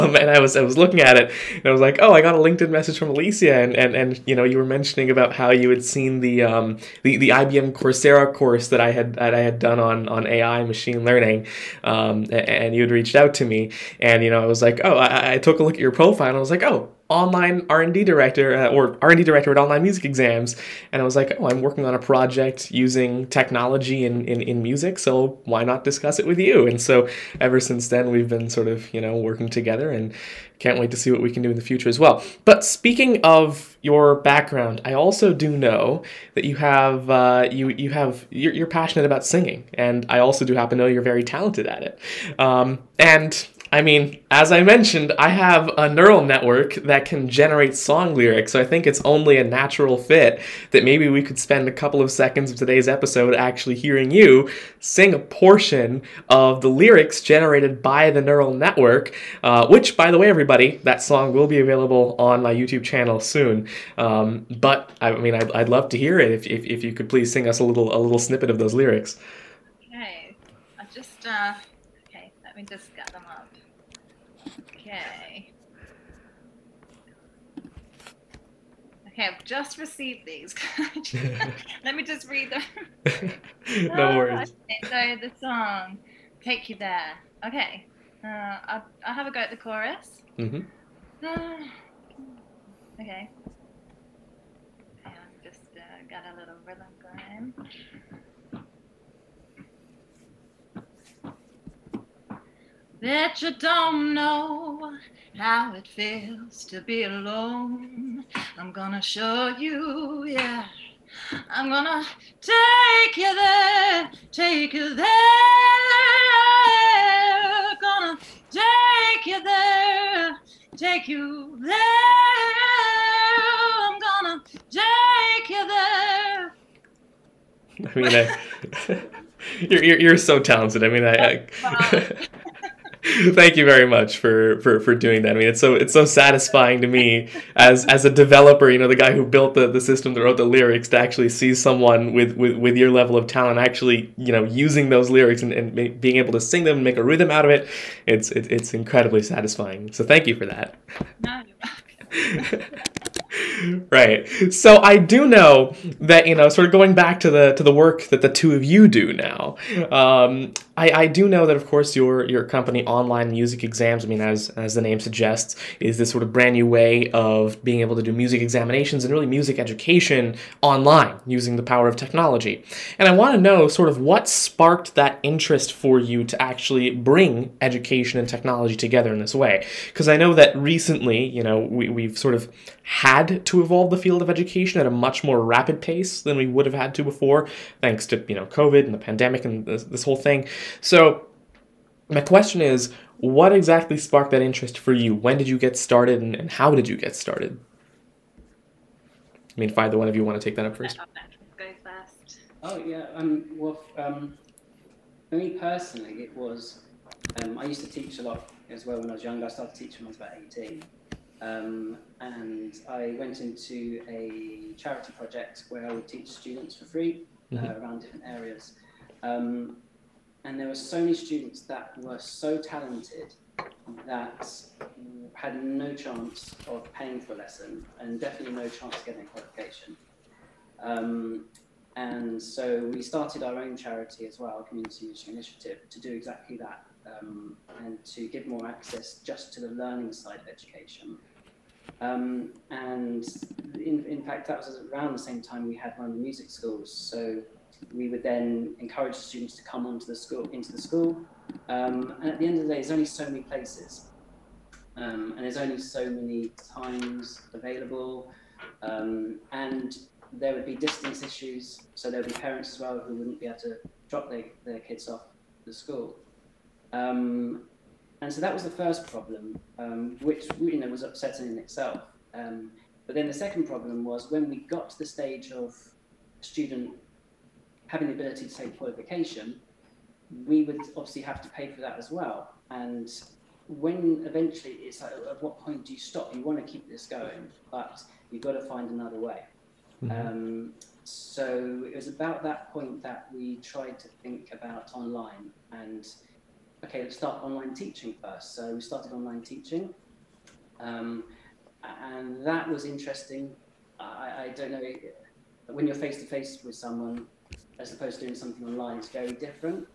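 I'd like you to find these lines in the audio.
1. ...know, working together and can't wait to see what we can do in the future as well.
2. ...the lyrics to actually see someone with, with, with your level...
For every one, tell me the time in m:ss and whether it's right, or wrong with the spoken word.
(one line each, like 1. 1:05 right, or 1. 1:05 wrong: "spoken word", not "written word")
1. 0:29 right
2. 2:20 right.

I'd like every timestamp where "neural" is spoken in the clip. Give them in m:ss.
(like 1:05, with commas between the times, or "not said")
0:45, 0:58.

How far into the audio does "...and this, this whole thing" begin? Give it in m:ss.
3:09.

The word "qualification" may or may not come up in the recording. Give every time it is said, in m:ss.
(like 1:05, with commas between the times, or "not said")
3:49, 4:38.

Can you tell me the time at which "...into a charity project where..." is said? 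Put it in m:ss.
3:33.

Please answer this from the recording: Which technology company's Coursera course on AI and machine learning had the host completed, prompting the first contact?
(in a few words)
IBM.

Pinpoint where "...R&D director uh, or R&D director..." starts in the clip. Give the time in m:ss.
0:17.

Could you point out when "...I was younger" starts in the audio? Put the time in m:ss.
3:29.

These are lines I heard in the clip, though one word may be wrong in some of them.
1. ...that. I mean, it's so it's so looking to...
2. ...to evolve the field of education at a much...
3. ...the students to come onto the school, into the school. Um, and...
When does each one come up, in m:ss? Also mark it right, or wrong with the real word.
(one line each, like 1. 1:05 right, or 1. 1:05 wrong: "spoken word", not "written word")
1. 2:15 wrong: "satisfying", not "looking"
2. 3:03 right
3. 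4:09 right.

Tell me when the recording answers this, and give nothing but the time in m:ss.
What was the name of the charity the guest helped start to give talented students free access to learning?
3:54.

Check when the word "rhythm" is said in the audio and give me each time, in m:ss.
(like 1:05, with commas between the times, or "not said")
1:36, 2:27.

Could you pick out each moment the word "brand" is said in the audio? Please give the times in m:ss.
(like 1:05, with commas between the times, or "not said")
2:46.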